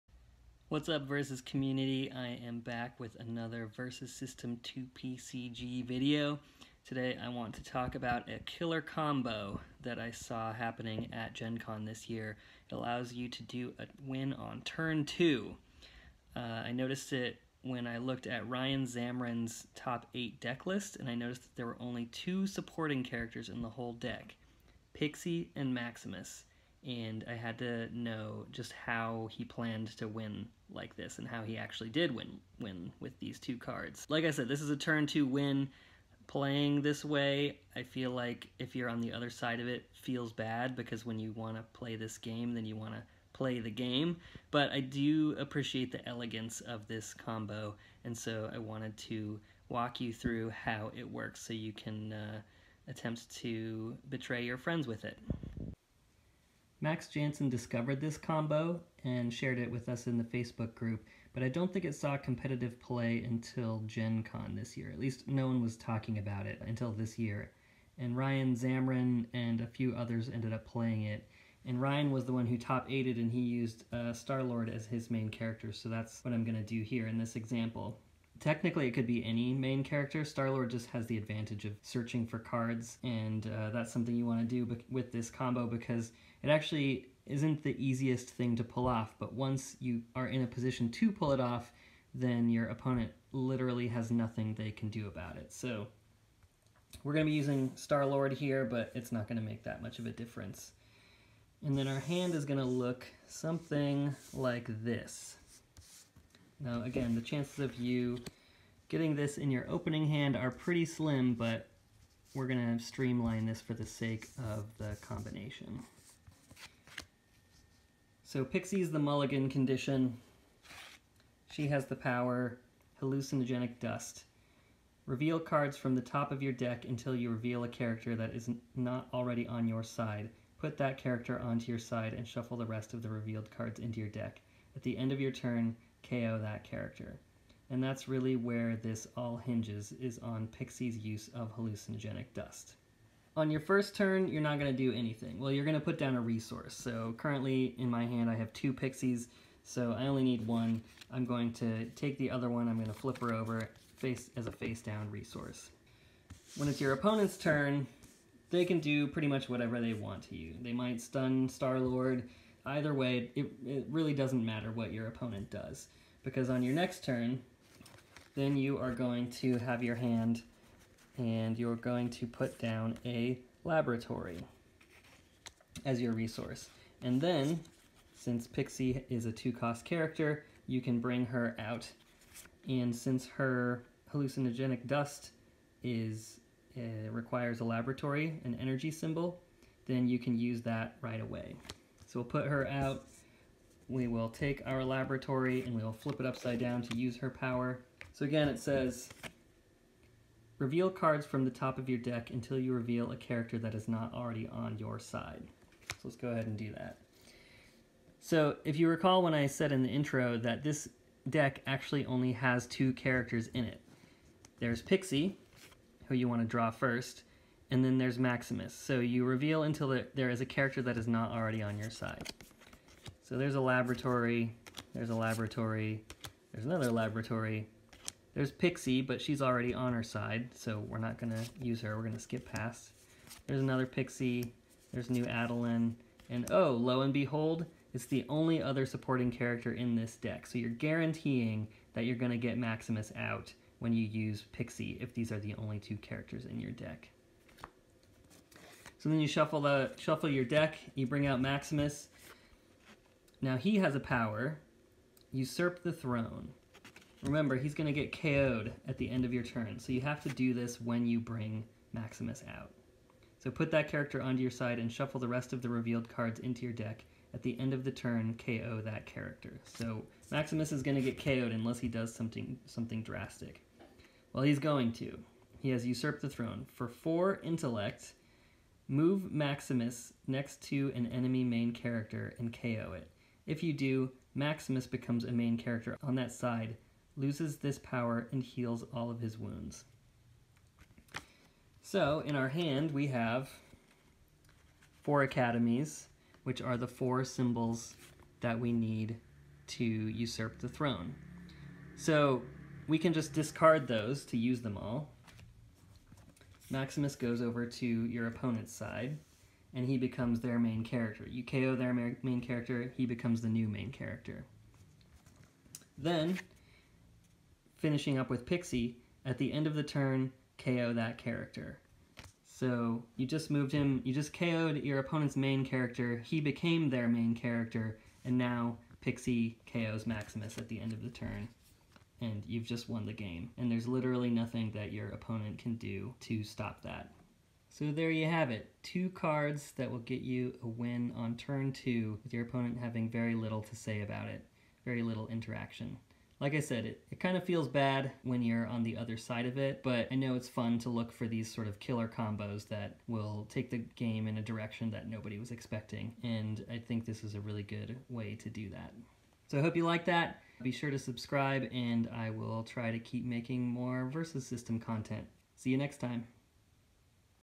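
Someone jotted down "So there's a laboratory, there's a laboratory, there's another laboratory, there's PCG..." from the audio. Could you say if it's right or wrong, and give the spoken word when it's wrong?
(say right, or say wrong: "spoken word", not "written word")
wrong: "Pixie", not "PCG".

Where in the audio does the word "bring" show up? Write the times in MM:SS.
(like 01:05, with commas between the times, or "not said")
03:00, 04:11, 04:21.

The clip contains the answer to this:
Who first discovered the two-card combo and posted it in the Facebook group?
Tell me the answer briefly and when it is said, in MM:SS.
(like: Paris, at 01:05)
Max Jansen, at 00:56.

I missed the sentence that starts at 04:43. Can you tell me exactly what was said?
If you do, Maximus becomes a main character on that side, loses this power, and heals all of his wounds.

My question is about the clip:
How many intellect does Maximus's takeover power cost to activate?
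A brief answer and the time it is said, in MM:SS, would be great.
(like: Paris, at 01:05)
4, at 04:36.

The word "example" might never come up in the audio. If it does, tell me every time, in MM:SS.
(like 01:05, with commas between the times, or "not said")
01:17.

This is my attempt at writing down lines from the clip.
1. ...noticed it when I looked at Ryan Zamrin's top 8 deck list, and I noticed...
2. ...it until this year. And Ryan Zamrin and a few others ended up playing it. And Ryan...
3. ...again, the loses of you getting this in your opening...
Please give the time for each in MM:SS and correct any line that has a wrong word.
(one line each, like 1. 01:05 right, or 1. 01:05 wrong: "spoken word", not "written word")
1. 00:16 right
2. 01:06 right
3. 01:46 wrong: "chances", not "loses".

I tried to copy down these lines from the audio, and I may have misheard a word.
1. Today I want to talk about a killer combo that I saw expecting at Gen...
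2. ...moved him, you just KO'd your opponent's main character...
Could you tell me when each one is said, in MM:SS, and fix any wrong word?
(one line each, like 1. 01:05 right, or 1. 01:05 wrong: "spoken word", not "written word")
1. 00:06 wrong: "happening", not "expecting"
2. 05:23 right.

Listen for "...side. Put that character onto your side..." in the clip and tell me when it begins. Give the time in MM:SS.
02:09.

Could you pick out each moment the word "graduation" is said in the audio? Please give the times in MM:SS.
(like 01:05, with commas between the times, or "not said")
not said.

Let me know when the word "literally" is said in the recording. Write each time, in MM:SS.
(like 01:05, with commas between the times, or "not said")
01:33, 05:33.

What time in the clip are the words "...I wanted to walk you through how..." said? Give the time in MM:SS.
00:48.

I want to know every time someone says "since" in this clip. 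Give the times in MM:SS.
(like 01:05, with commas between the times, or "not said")
02:58, 03:02.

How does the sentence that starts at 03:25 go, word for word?
So let's go ahead and do that.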